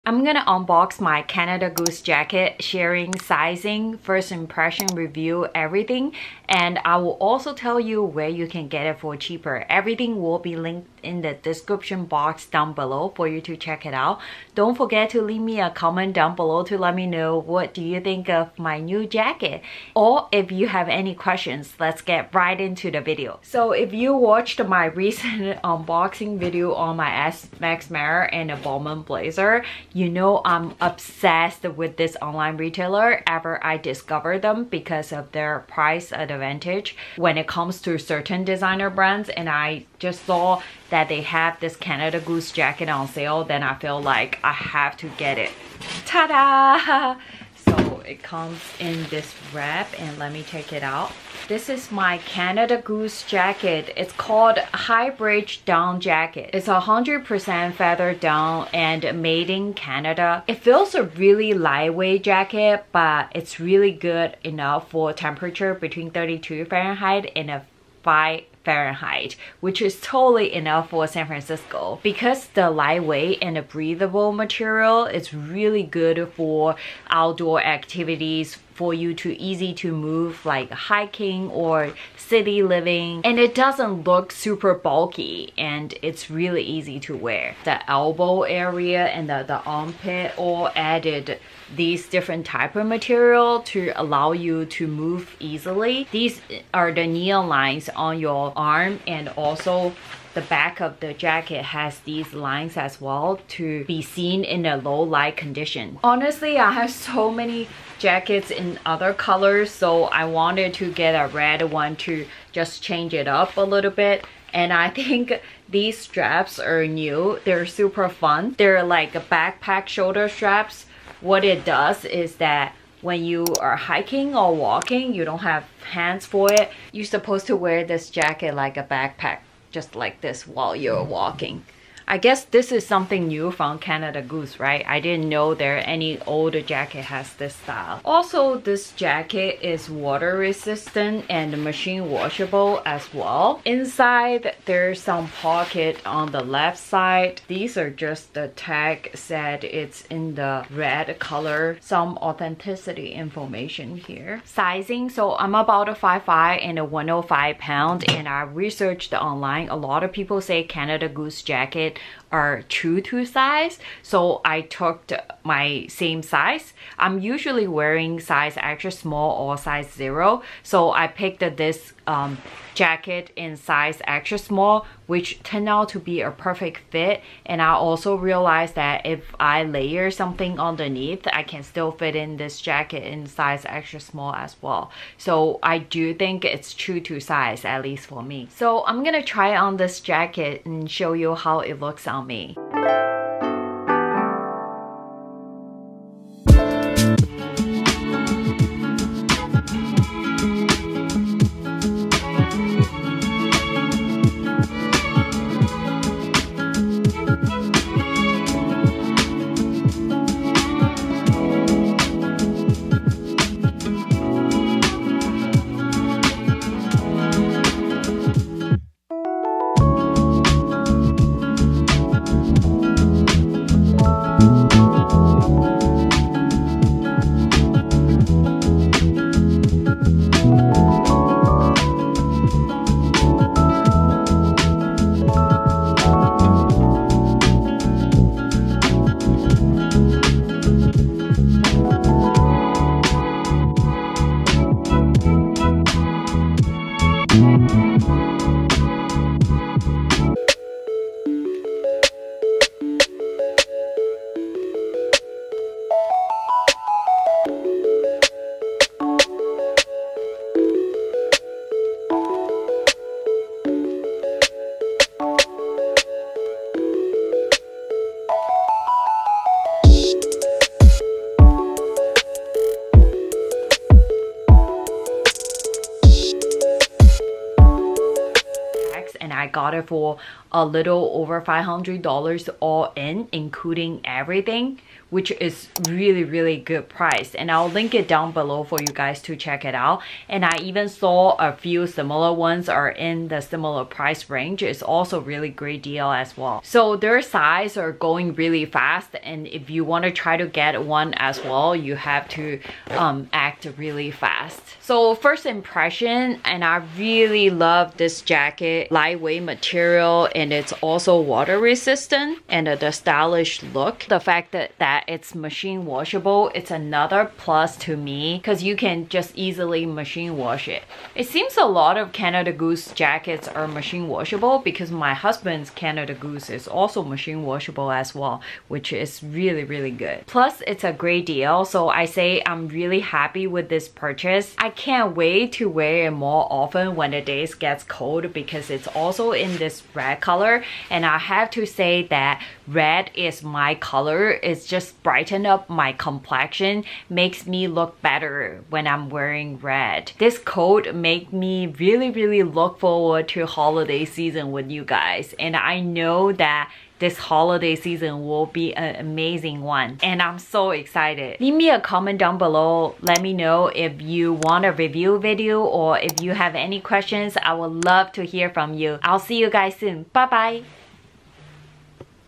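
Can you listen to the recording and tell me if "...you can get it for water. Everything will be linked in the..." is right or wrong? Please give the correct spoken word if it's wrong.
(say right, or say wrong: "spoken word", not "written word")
wrong: "cheaper", not "water".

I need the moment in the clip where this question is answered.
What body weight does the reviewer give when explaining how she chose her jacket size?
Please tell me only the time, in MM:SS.
02:36.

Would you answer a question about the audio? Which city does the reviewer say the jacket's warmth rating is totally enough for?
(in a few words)
San Francisco.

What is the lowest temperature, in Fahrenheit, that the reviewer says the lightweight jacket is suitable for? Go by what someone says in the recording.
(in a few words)
5 Fahrenheit.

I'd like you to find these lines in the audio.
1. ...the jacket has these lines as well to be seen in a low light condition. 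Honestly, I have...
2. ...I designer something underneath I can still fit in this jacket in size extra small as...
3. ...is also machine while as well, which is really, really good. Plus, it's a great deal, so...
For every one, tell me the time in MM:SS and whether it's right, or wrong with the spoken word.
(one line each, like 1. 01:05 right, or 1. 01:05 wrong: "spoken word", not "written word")
1. 01:41 right
2. 02:59 wrong: "layer", not "designer"
3. 05:26 wrong: "washable", not "while".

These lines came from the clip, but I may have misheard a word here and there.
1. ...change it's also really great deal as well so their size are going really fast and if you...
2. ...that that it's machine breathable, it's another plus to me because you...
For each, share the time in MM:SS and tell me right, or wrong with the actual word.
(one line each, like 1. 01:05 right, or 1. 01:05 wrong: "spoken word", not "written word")
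1. 04:54 wrong: "range", not "change"
2. 05:14 wrong: "washable", not "breathable".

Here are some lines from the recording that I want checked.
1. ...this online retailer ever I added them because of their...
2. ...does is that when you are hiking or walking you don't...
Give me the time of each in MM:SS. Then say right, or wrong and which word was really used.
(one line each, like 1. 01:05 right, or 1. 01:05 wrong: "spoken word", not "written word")
1. 00:31 wrong: "discovered", not "added"
2. 02:01 right.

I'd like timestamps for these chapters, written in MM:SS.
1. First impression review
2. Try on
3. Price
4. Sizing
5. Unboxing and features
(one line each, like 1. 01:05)
1. 05:05
2. 03:09
3. 04:39
4. 02:34
5. 00:23.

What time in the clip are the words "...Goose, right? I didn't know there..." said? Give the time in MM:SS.
02:14.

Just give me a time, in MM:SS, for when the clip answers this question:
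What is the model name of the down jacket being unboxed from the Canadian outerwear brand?
00:54.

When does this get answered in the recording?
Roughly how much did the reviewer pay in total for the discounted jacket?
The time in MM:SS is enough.
04:40.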